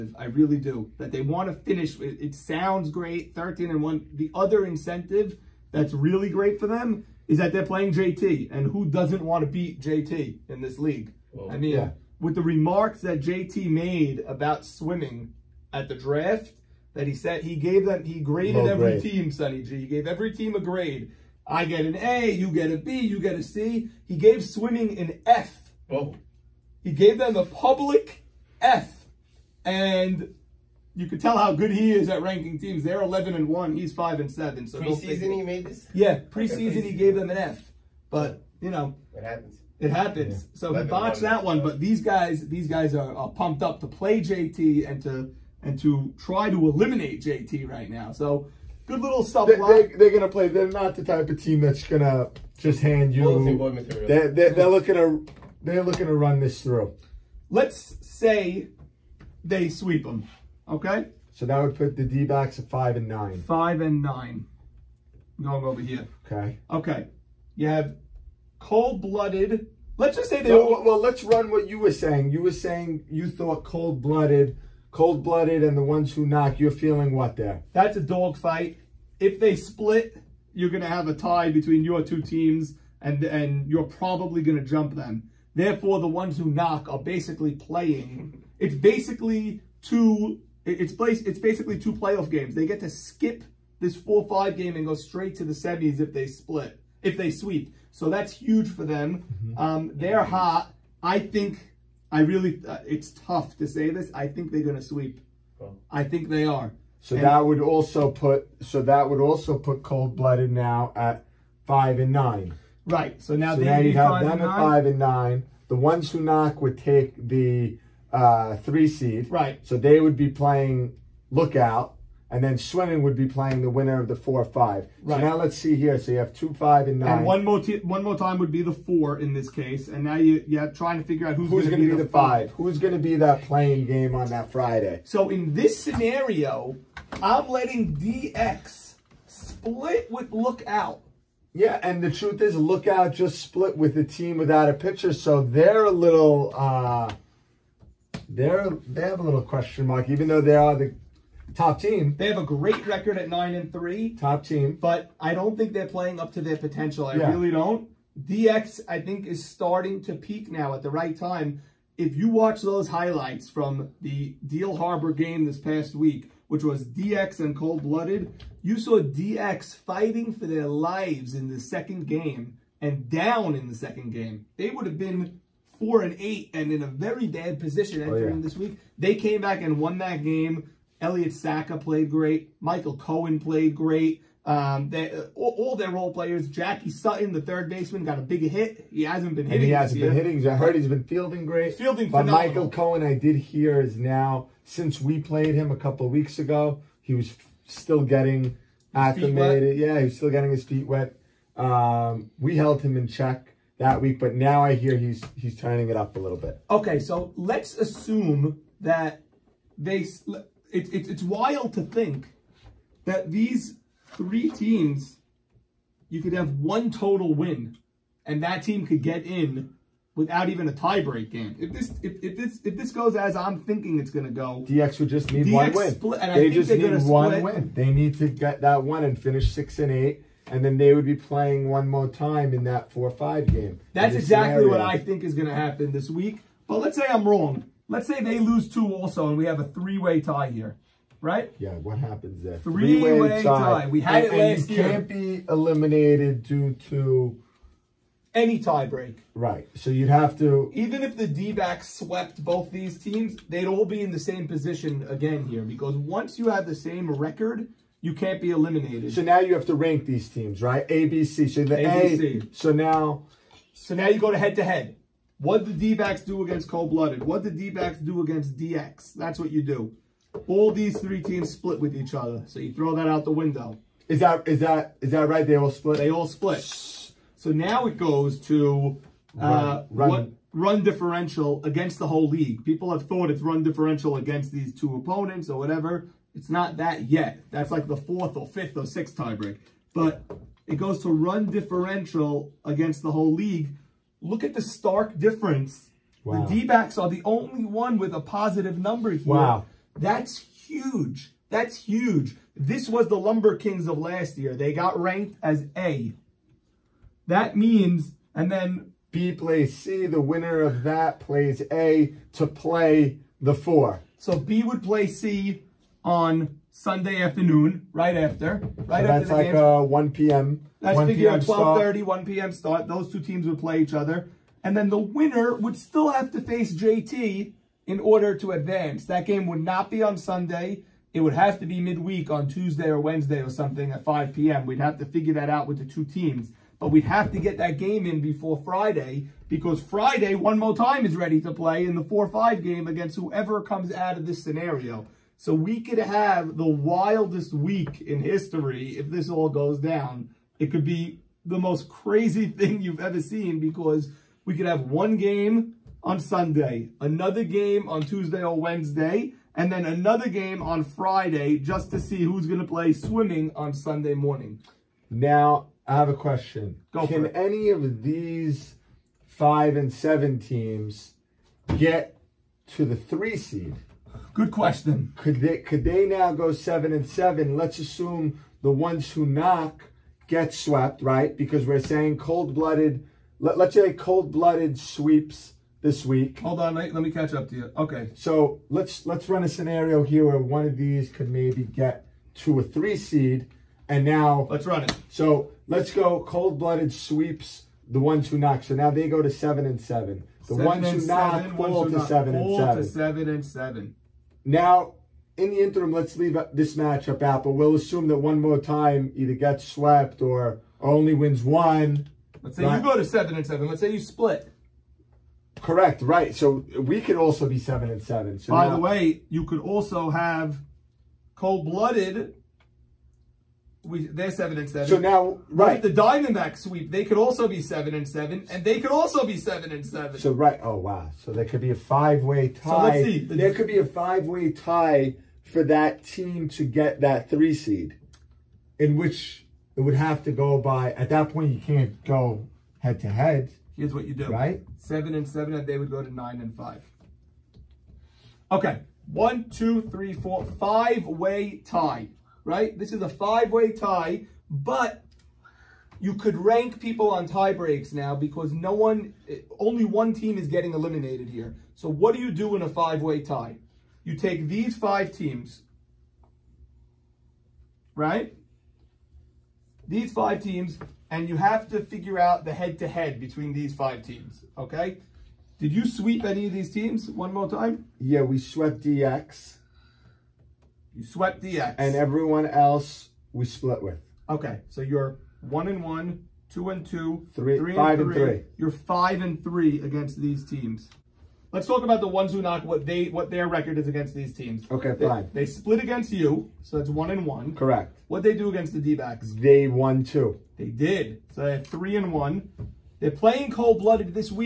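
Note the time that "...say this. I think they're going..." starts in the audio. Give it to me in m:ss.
1:43.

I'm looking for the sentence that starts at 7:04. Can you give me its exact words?
So now, right, With the Diamondback sweep, they could also be seven and seven, and they could also be seven and seven.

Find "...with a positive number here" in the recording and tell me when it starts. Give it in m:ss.
4:57.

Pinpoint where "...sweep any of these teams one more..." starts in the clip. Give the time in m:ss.
7:55.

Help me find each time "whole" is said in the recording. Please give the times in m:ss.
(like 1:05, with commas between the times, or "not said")
4:42, 4:53.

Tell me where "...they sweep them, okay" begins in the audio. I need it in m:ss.
0:59.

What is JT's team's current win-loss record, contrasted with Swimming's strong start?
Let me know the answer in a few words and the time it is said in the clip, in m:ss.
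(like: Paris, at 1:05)
5 and 7, at 0:33.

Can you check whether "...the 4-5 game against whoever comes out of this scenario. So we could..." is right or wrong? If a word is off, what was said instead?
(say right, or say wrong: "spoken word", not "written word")
right.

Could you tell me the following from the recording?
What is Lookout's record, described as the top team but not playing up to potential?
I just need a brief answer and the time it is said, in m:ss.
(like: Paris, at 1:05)
9 and 3, at 2:33.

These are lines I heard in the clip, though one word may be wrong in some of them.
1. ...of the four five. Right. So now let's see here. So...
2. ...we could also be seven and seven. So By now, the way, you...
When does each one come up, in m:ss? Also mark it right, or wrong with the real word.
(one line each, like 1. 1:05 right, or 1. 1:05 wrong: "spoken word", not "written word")
1. 2:03 right
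2. 6:56 right.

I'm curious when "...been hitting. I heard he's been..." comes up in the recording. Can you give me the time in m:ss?
3:09.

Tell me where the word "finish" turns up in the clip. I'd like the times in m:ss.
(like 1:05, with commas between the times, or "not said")
0:01, 3:49.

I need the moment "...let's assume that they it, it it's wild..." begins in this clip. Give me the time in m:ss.
3:27.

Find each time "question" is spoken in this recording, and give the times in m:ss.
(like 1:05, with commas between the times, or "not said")
2:29, 6:06, 6:14.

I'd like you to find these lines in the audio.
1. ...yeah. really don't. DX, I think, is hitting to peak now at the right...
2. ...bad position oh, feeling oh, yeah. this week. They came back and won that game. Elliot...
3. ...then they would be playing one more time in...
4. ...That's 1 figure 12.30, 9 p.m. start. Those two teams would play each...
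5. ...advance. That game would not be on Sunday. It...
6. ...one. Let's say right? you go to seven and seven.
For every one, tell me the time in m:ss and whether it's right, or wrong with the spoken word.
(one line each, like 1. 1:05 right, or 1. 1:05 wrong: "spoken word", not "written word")
1. 2:37 wrong: "starting", not "hitting"
2. 2:57 wrong: "entering", not "feeling"
3. 3:50 right
4. 5:20 wrong: "1", not "9"
5. 5:28 right
6. 6:51 right.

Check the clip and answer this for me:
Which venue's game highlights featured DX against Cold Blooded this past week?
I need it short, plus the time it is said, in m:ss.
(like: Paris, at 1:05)
Deal Harbor, at 2:44.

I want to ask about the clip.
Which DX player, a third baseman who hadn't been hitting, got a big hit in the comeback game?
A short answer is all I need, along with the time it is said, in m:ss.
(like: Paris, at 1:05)
Jackie Sutton, at 3:06.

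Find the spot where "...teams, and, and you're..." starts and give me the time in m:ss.
1:22.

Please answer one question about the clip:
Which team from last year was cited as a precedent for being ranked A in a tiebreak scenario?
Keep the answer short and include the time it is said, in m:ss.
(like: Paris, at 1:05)
Lumber Kings, at 5:03.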